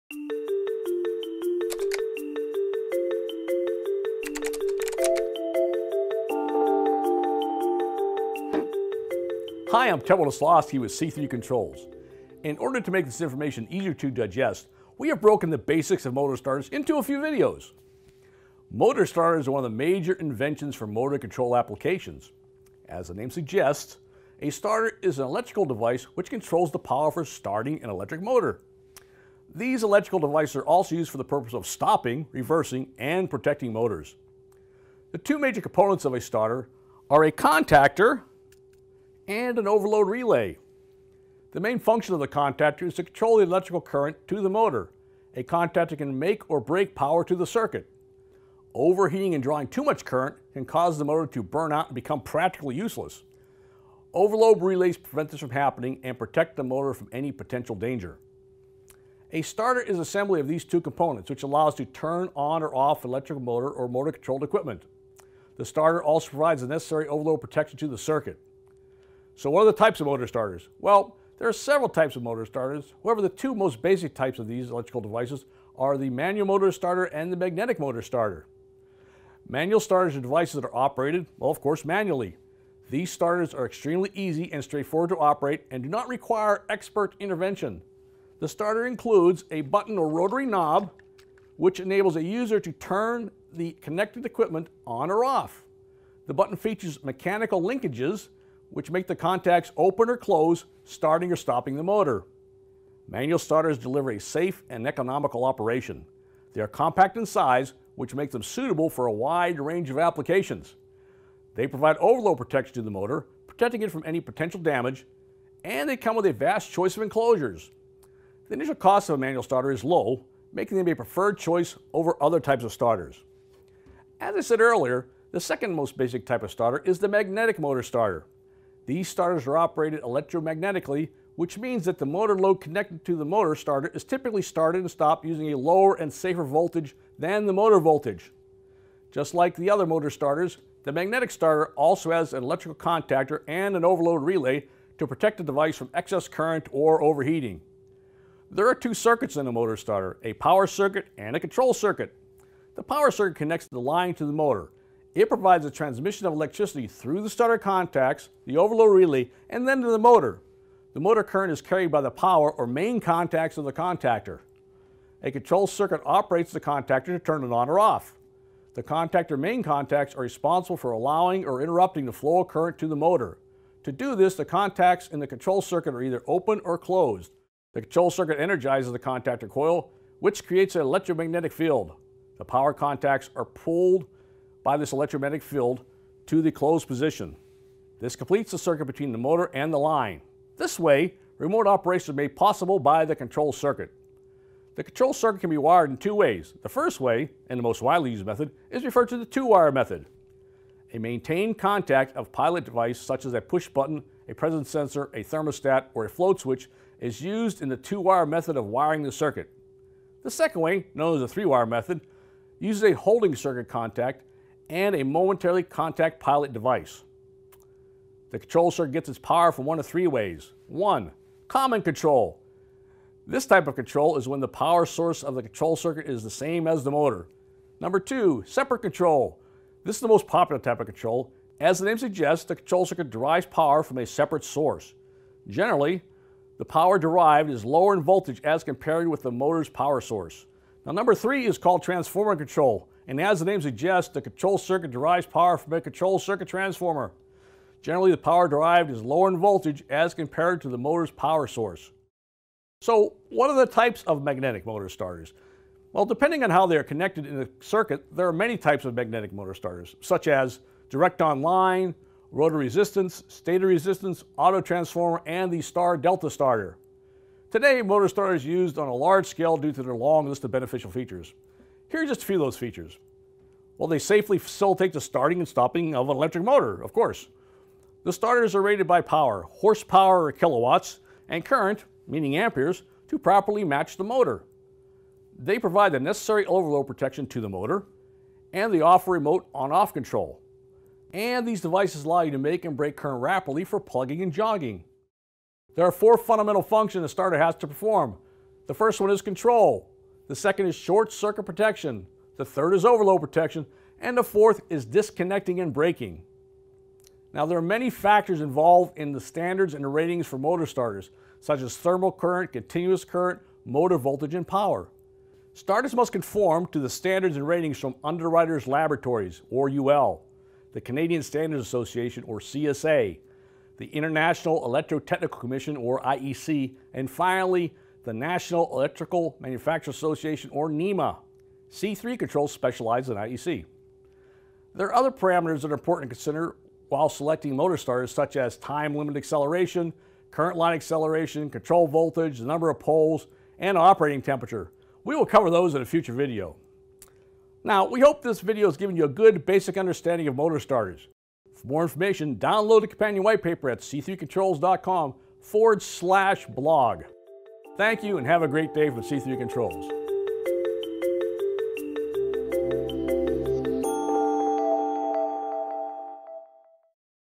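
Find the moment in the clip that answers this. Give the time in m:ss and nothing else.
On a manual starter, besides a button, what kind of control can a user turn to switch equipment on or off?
1:30.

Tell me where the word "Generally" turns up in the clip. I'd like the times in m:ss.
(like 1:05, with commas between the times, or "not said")
3:55, 4:07.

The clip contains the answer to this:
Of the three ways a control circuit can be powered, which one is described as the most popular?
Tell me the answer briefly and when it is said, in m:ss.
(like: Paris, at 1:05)
separate control, at 3:48.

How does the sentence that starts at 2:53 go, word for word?
To do this, the contacts in the control circuit are either open or closed.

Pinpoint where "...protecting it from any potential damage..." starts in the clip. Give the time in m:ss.
1:53.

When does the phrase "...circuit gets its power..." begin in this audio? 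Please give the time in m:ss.
3:38.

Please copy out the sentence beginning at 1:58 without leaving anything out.
The initial cost of a manual starter is low, making them a preferred choice over other types of starters.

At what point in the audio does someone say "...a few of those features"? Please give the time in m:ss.
4:32.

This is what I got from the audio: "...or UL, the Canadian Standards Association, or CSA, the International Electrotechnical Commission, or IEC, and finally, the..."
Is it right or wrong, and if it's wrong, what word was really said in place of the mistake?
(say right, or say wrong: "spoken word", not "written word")
right.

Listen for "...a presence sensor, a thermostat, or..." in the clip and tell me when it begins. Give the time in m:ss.
3:24.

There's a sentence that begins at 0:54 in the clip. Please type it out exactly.
Overload relays prevent this from happening and protect the motor from any potential danger.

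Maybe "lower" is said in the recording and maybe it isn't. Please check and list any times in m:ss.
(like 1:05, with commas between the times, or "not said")
2:15, 3:57, 4:09.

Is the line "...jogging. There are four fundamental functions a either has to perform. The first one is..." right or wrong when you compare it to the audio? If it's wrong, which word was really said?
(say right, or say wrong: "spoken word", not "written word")
wrong: "starter", not "either".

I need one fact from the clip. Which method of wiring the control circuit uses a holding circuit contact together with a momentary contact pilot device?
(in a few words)
three-wire method.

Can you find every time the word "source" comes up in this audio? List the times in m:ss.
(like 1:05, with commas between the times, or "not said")
3:44, 3:54, 3:59, 4:11.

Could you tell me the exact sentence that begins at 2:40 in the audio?
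The motor current is carried by the power or main contacts of the contactor.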